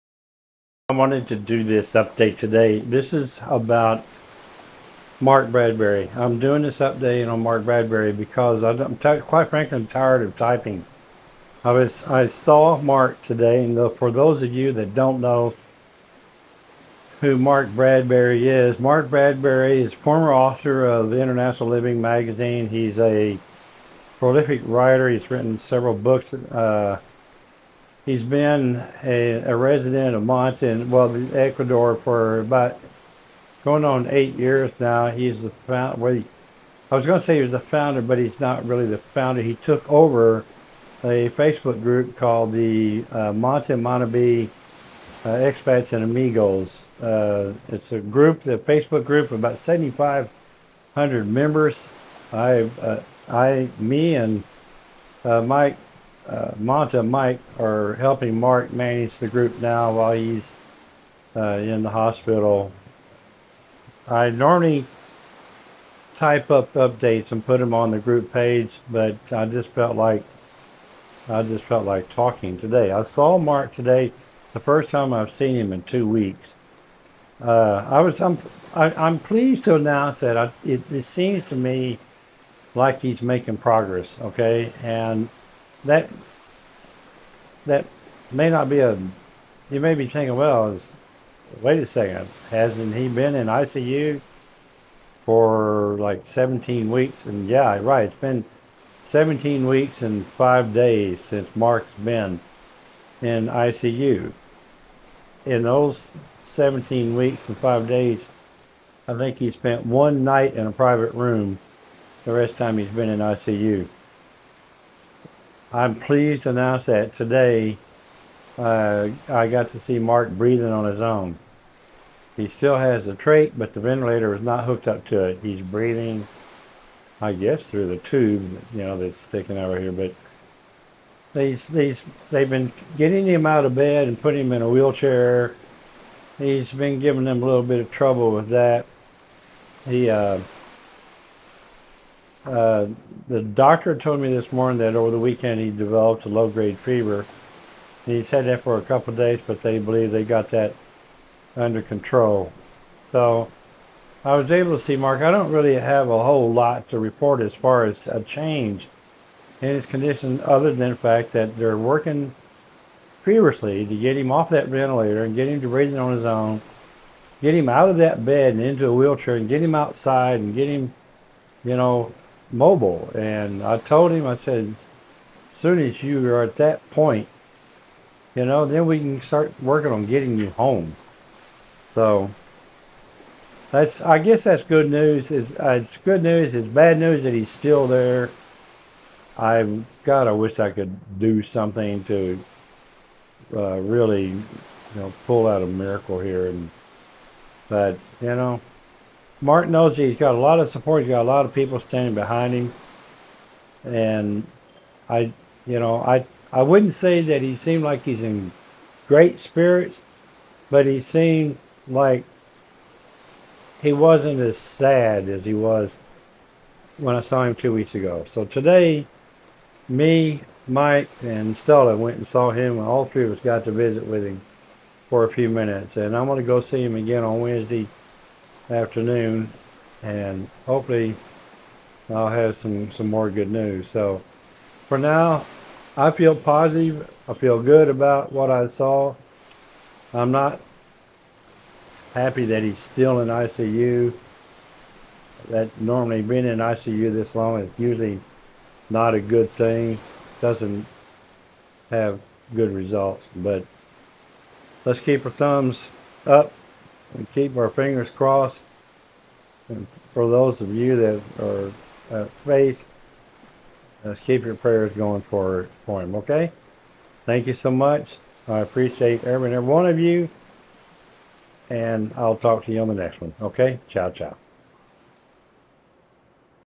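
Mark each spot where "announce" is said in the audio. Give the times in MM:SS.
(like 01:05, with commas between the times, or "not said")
01:19, 01:56.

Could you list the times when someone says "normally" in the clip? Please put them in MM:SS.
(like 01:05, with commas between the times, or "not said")
01:04, 04:05.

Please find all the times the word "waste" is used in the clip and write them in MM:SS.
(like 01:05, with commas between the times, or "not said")
not said.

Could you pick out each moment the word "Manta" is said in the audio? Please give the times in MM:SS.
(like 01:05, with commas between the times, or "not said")
00:30, 00:43, 00:56.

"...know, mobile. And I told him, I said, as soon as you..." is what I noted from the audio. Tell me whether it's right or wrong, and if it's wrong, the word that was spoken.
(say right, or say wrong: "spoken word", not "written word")
right.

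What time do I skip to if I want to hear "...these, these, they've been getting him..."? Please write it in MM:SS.
02:11.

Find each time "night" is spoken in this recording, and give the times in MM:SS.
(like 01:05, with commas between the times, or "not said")
01:50.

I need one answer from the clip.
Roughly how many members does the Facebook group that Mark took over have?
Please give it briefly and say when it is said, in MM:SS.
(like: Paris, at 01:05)
7,500, at 00:49.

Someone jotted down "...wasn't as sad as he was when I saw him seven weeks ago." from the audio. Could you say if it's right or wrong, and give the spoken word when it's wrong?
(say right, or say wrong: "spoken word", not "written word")
wrong: "two", not "seven".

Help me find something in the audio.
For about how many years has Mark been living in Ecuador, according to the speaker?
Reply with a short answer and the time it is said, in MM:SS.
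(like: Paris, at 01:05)
8, at 00:34.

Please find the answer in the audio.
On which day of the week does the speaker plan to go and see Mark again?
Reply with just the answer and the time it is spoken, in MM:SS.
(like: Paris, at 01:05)
Wednesday, at 03:47.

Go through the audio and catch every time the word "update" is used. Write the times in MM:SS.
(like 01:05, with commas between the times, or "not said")
00:01, 00:06, 01:06.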